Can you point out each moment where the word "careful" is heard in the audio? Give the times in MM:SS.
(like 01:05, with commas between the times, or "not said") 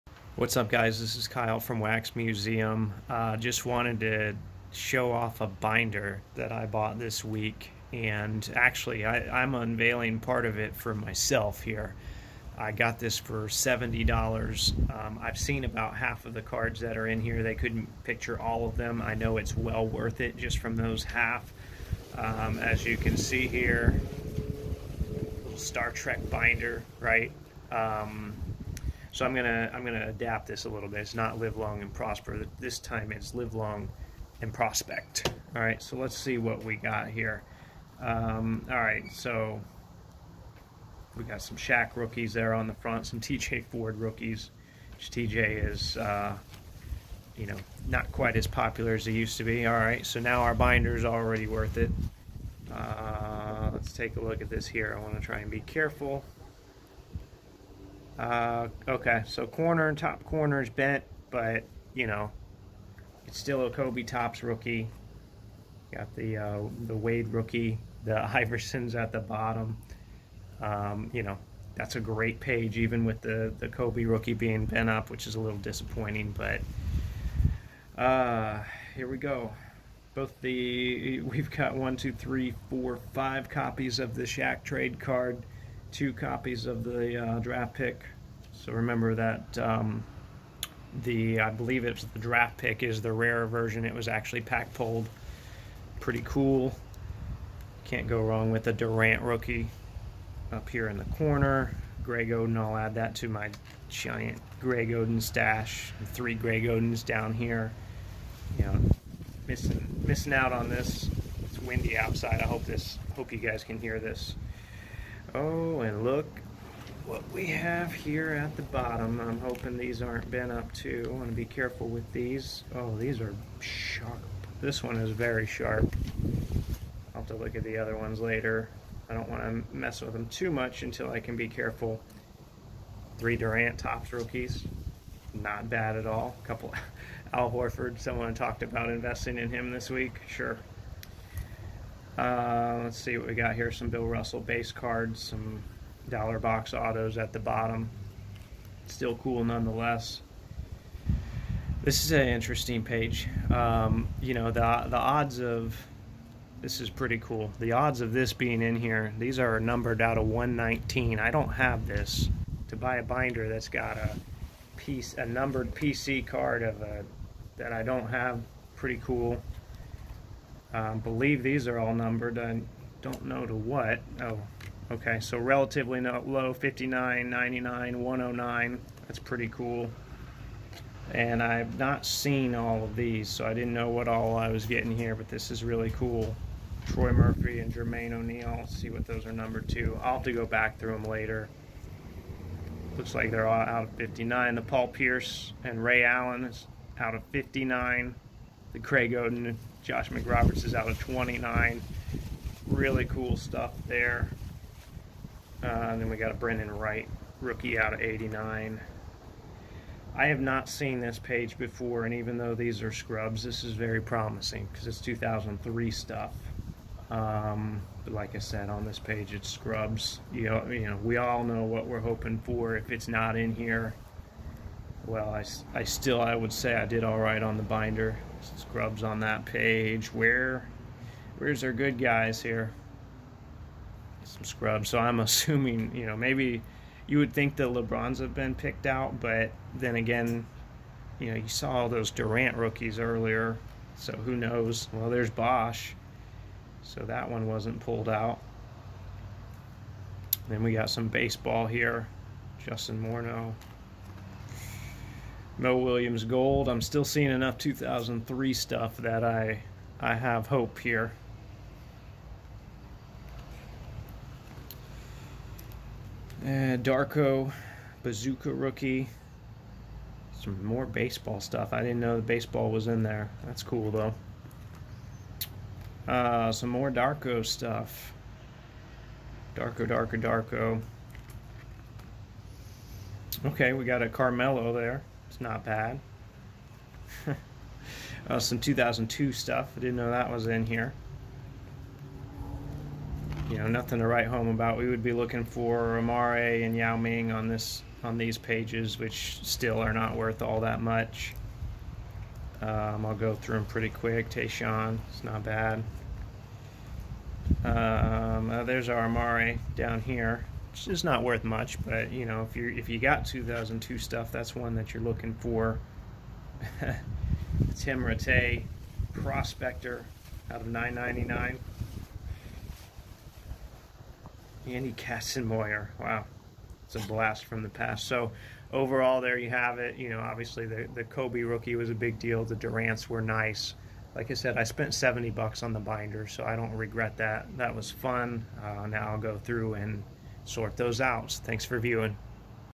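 00:55, 02:01, 02:11.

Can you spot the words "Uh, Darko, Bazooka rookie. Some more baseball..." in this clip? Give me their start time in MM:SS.
04:26.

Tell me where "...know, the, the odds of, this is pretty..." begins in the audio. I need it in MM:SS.
02:34.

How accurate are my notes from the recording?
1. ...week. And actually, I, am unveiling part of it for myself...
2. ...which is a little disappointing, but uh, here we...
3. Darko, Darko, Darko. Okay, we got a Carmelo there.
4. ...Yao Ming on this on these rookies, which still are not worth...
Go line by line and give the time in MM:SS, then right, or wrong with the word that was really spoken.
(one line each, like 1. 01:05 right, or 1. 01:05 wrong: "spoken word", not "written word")
1. 00:07 right
2. 01:15 right
3. 04:39 right
4. 04:56 wrong: "pages", not "rookies".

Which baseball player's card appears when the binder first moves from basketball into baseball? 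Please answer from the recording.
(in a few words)
Justin Morneau.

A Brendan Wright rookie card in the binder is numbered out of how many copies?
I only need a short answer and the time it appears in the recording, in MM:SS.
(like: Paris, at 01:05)
89, at 03:28.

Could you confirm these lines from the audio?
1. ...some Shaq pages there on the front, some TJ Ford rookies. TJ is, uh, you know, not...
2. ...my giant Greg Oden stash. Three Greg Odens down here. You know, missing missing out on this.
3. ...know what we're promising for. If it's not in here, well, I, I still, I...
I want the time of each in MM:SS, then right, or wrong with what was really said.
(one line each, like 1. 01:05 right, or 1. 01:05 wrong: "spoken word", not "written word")
1. 00:41 wrong: "rookies", not "pages"
2. 01:43 right
3. 03:41 wrong: "hoping", not "promising".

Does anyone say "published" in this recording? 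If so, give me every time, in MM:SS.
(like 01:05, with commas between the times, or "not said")
not said.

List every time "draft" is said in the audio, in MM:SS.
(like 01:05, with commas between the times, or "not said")
01:27, 01:32.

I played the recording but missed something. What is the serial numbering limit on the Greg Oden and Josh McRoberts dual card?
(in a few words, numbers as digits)
29.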